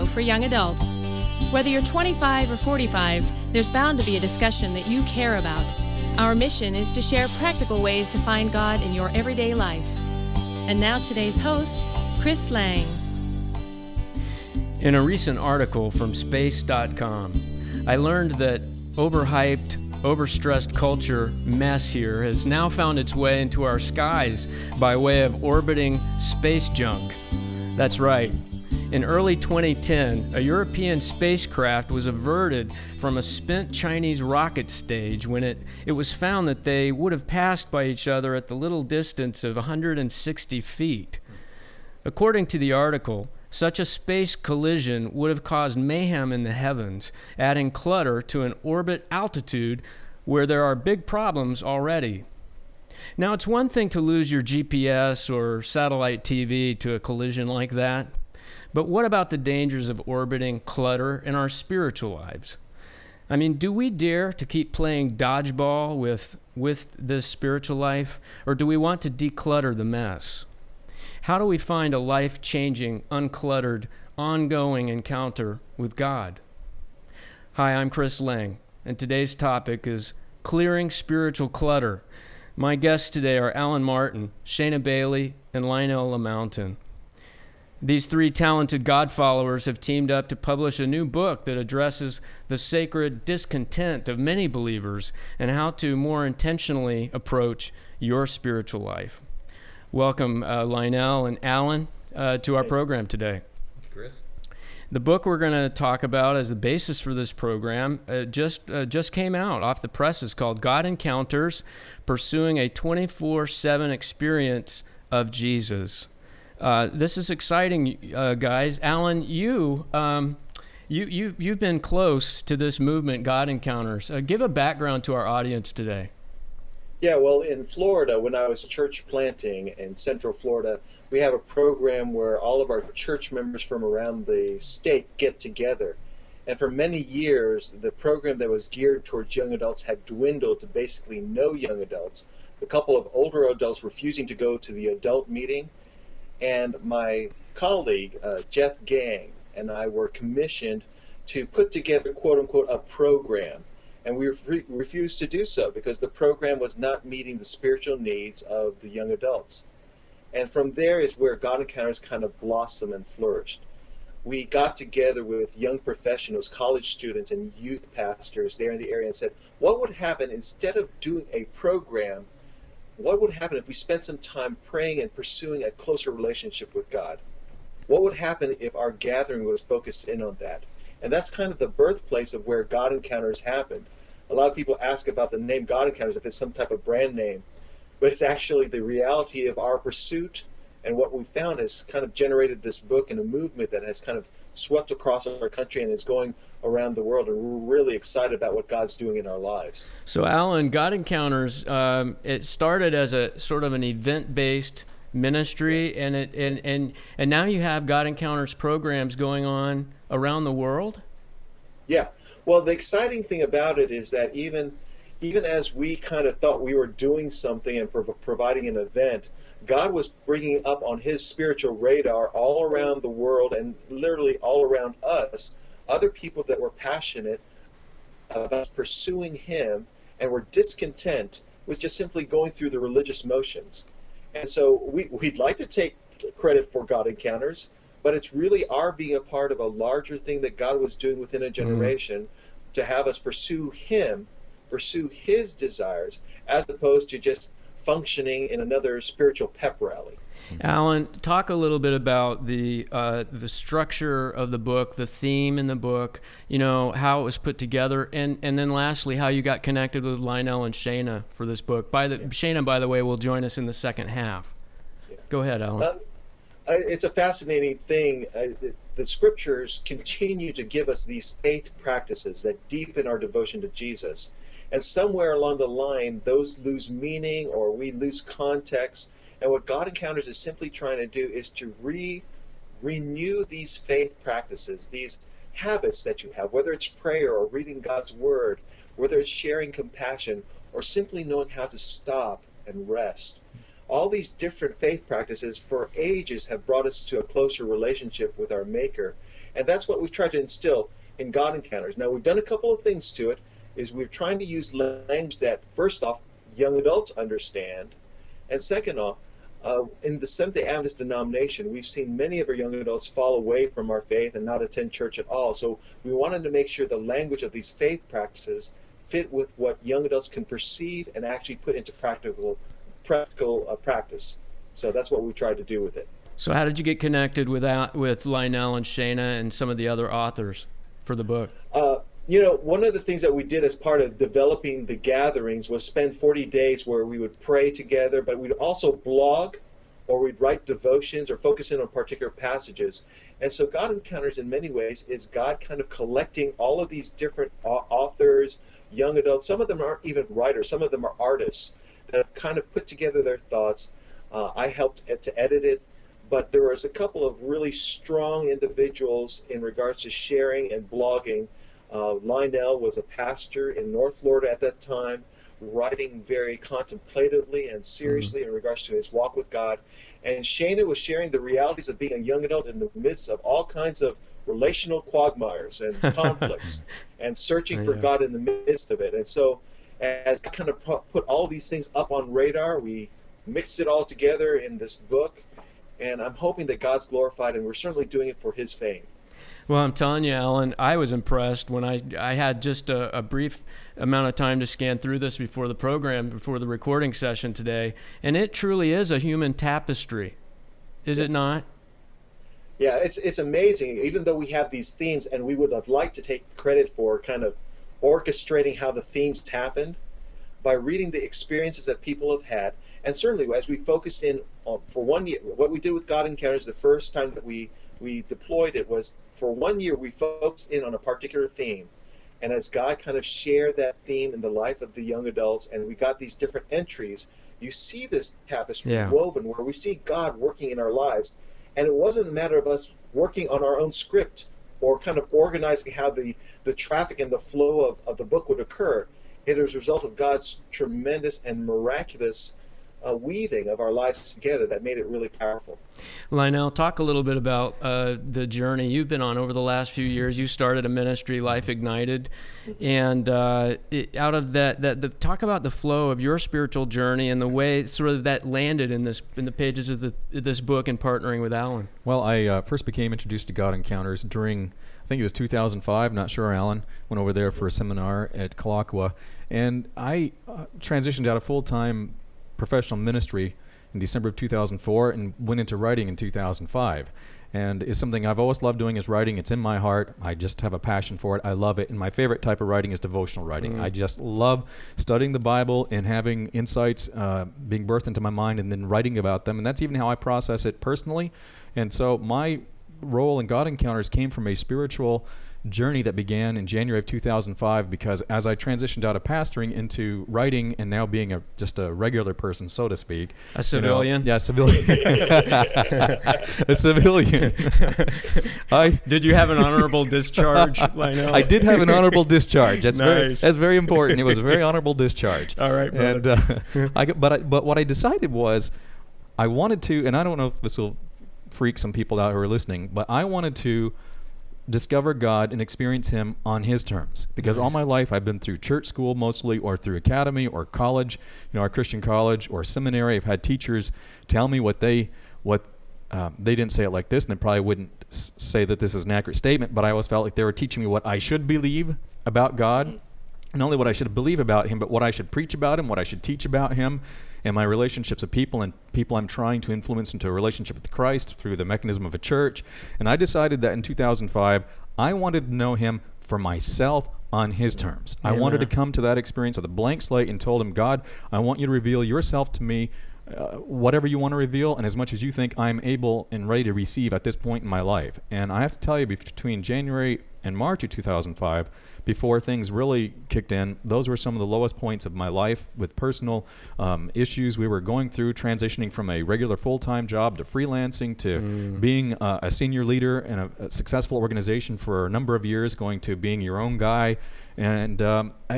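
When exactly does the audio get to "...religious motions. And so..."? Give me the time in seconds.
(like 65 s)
232 s.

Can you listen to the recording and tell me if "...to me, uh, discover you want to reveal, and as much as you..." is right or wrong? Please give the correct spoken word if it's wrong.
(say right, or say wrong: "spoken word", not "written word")
wrong: "whatever", not "discover".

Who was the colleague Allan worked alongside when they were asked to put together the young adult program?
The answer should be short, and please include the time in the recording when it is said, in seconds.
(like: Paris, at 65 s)
Jeff Gang, at 148 s.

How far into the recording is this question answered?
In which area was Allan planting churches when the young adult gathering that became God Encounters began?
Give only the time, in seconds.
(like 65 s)
129 s.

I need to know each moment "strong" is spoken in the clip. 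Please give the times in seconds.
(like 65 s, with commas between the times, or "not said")
357 s.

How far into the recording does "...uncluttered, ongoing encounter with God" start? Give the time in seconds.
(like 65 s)
73 s.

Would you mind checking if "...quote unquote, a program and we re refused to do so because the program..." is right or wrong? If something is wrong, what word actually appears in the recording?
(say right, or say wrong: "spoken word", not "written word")
right.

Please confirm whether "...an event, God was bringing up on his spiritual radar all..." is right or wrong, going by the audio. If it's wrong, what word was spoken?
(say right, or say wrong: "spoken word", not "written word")
right.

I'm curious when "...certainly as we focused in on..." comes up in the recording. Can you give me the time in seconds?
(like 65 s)
413 s.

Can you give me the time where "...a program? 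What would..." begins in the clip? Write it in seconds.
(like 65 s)
171 s.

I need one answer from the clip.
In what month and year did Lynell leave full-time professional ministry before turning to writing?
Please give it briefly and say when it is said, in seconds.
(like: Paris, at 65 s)
December 2004, at 473 s.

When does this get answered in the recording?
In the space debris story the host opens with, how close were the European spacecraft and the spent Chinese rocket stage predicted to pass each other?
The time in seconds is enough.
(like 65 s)
39 s.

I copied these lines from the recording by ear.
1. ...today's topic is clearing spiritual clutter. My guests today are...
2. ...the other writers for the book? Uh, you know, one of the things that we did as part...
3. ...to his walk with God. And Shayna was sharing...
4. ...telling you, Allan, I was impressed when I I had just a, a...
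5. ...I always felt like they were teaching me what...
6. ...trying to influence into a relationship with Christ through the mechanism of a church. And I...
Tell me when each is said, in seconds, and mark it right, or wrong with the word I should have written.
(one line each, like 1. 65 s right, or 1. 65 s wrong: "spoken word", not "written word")
1. 78 s right
2. 329 s wrong: "authors", not "writers"
3. 368 s right
4. 389 s right
5. 539 s right
6. 549 s right.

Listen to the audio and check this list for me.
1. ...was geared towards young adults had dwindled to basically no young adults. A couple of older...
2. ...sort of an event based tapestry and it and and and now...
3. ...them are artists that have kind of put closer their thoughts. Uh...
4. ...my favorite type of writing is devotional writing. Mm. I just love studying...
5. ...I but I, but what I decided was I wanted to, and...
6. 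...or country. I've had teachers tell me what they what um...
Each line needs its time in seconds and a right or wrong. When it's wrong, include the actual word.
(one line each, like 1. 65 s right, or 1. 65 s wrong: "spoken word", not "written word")
1. 138 s right
2. 203 s wrong: "ministry", not "tapestry"
3. 350 s wrong: "together", not "closer"
4. 481 s right
5. 516 s right
6. 532 s wrong: "seminary", not "country".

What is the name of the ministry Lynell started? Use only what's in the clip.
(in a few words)
Life Ignited.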